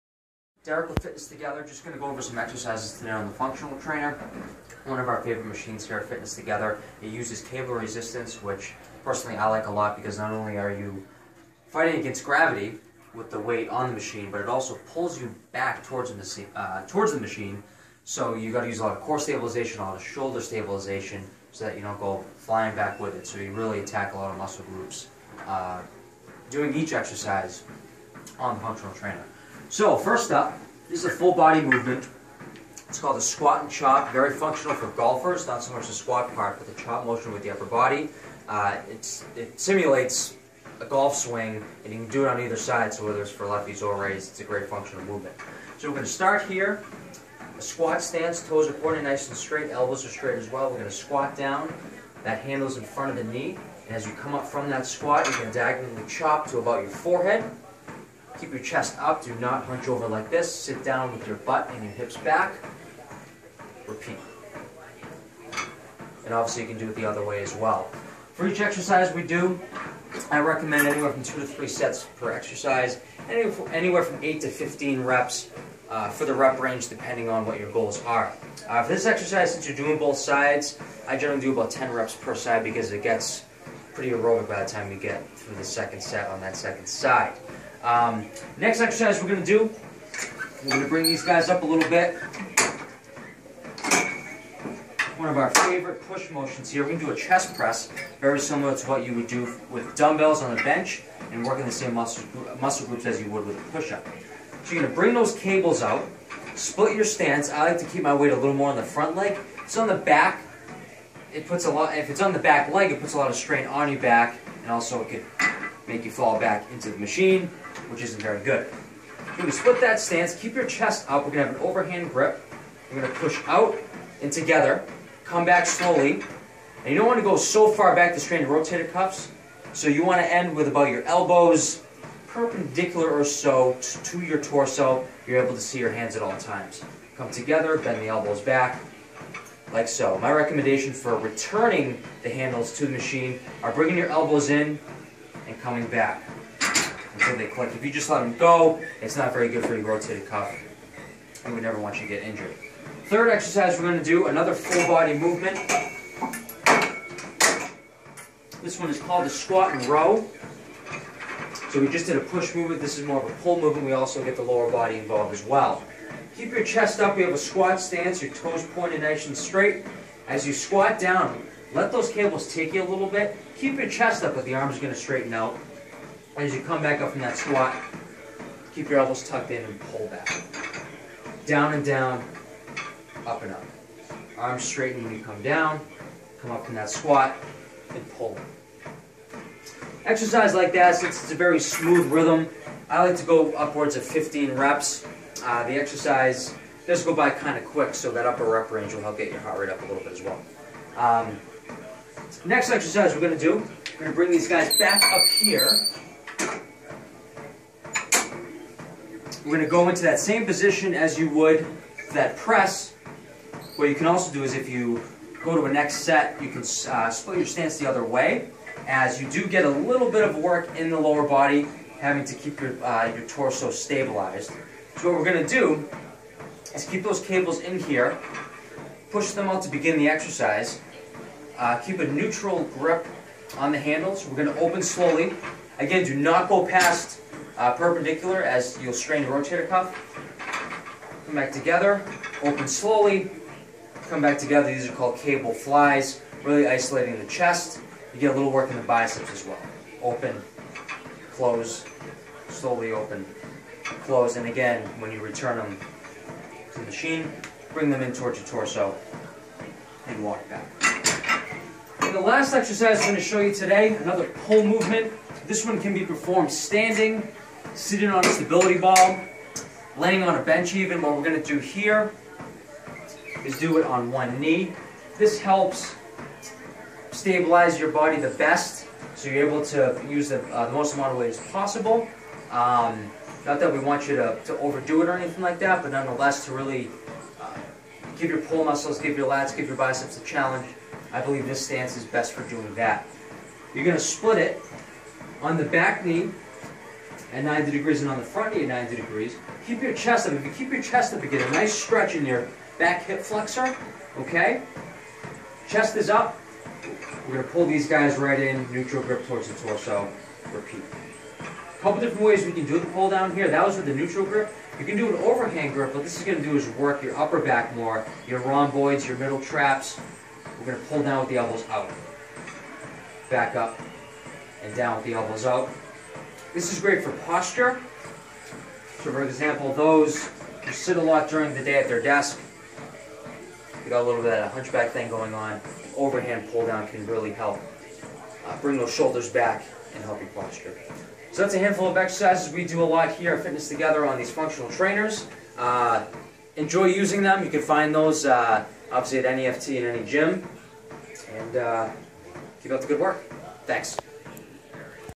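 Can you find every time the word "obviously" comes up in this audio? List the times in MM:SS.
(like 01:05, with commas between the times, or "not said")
01:06, 05:48.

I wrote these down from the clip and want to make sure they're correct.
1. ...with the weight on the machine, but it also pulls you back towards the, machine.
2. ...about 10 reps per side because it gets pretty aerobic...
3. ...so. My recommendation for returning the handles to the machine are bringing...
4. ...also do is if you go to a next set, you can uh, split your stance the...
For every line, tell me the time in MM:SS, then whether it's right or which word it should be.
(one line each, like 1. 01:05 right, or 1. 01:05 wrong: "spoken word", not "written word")
1. 00:13 right
2. 01:21 right
3. 02:19 right
4. 03:34 right.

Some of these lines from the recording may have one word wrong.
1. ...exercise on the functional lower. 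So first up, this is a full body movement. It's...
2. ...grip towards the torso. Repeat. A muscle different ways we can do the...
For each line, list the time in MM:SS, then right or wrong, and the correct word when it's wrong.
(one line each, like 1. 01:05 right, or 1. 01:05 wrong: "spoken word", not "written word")
1. 00:26 wrong: "trainer", not "lower"
2. 05:09 wrong: "couple", not "muscle".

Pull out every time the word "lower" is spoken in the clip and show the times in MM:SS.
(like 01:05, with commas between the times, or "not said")
02:44, 03:40.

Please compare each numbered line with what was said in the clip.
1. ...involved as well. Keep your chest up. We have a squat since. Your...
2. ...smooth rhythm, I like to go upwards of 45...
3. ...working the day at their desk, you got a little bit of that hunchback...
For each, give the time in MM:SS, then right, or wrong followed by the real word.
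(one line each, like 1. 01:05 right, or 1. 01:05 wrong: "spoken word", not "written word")
1. 02:44 wrong: "stance", not "since"
2. 03:11 wrong: "15", not "45"
3. 05:31 wrong: "during", not "working".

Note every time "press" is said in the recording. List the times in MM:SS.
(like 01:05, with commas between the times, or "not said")
01:37, 03:32.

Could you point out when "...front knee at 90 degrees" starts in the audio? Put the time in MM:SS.
04:58.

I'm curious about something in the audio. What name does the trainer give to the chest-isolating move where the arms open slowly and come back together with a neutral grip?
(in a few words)
Cable flies.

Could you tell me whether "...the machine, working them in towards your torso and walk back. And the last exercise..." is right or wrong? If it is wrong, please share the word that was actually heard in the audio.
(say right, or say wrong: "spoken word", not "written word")
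wrong: "bring", not "working".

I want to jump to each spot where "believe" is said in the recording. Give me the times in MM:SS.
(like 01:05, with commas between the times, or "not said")
04:51.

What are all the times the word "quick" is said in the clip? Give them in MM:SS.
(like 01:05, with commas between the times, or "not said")
03:17.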